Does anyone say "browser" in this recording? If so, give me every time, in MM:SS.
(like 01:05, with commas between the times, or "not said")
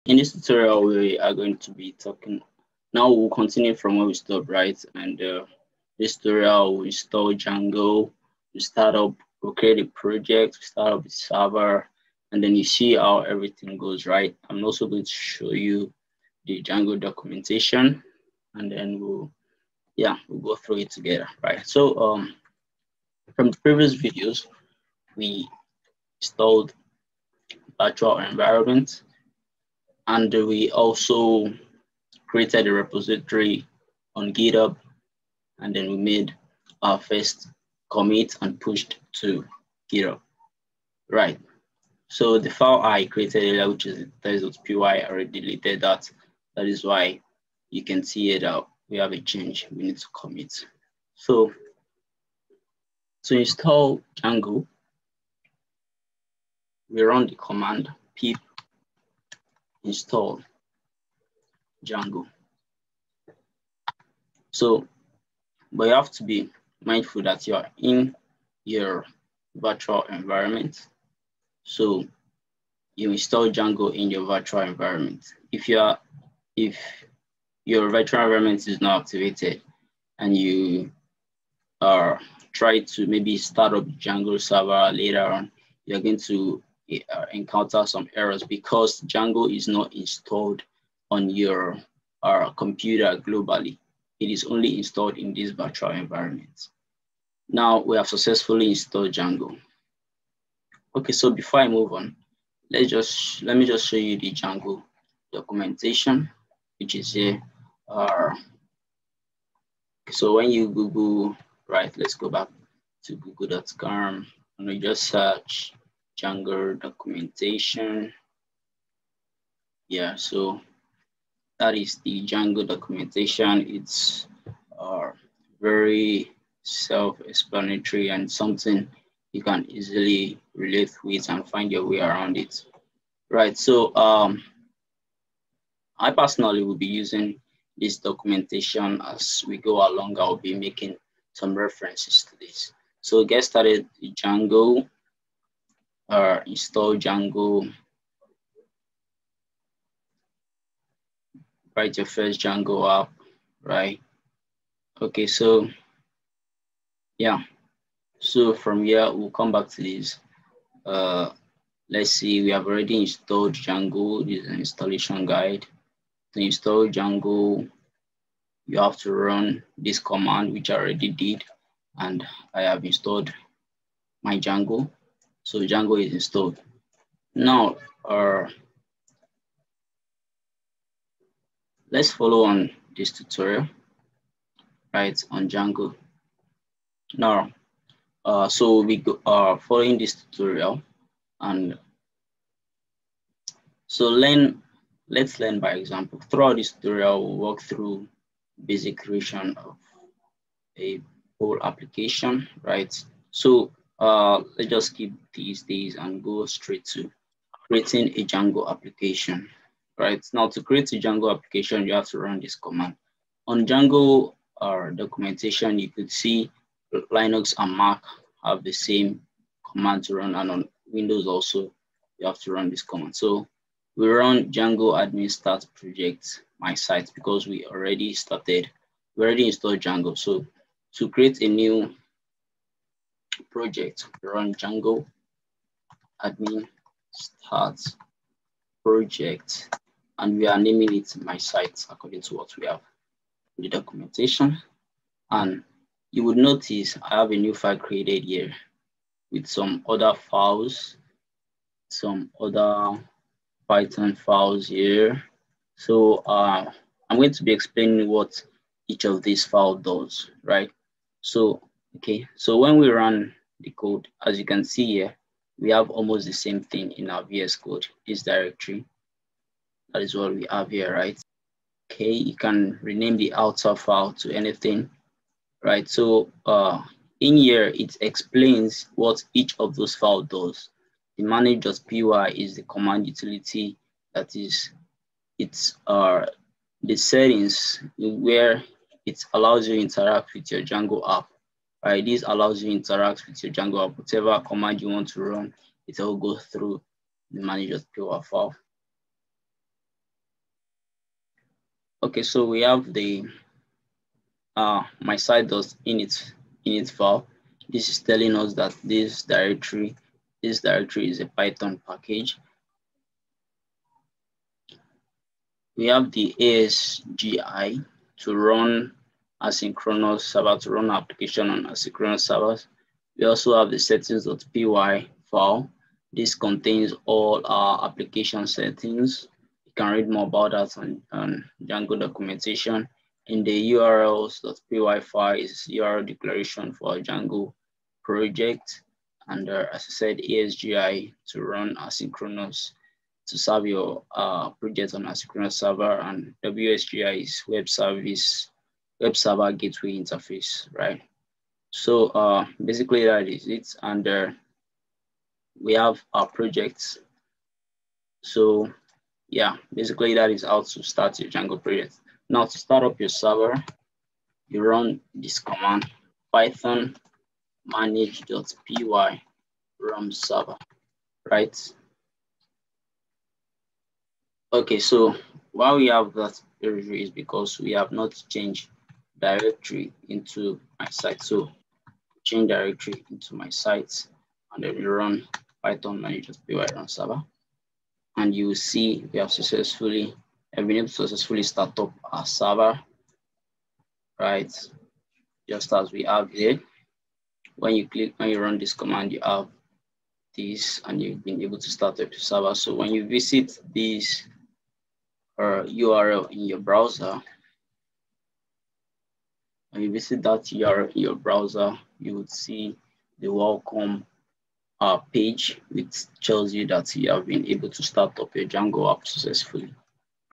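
06:46, 06:51.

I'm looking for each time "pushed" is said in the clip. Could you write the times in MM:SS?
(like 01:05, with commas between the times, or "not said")
00:38.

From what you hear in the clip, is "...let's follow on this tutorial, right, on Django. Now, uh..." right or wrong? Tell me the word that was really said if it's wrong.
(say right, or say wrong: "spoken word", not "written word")
right.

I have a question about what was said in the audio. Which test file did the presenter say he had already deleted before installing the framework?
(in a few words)
test.py.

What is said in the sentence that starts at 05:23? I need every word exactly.
We also have the settings.py file.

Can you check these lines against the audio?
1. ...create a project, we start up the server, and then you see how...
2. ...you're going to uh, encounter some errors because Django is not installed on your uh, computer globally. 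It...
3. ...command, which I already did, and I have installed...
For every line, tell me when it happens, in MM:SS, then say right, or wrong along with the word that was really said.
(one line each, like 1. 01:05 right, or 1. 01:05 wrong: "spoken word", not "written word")
1. 00:09 right
2. 01:25 right
3. 02:49 right.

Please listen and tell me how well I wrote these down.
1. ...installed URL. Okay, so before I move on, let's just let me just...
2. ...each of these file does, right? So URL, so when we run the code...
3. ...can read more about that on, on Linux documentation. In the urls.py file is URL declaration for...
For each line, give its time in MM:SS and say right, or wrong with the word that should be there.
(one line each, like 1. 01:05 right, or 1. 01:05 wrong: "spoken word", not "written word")
1. 01:38 wrong: "Django", not "URL"
2. 04:18 wrong: "Okay", not "URL"
3. 05:29 wrong: "Django", not "Linux".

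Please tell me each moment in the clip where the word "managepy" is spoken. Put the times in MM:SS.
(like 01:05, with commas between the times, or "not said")
04:41, 04:57, 06:07, 06:26.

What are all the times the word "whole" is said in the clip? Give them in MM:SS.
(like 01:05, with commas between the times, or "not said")
03:21.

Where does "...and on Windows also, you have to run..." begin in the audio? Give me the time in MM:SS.
03:40.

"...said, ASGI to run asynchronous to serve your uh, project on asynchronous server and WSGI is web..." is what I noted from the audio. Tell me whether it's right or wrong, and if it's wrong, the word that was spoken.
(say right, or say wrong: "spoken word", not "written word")
right.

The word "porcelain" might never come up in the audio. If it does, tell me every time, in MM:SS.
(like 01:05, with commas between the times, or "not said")
not said.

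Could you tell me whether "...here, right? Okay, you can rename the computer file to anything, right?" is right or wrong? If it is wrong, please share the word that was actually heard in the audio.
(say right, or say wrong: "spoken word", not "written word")
wrong: "outer", not "computer".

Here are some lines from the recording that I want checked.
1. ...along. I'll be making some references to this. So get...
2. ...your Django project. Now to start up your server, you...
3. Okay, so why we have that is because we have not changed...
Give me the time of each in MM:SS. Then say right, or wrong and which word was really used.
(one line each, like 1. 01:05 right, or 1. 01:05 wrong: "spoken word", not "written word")
1. 02:19 right
2. 06:01 right
3. 06:14 right.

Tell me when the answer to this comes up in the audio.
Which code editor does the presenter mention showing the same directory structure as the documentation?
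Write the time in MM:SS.
04:27.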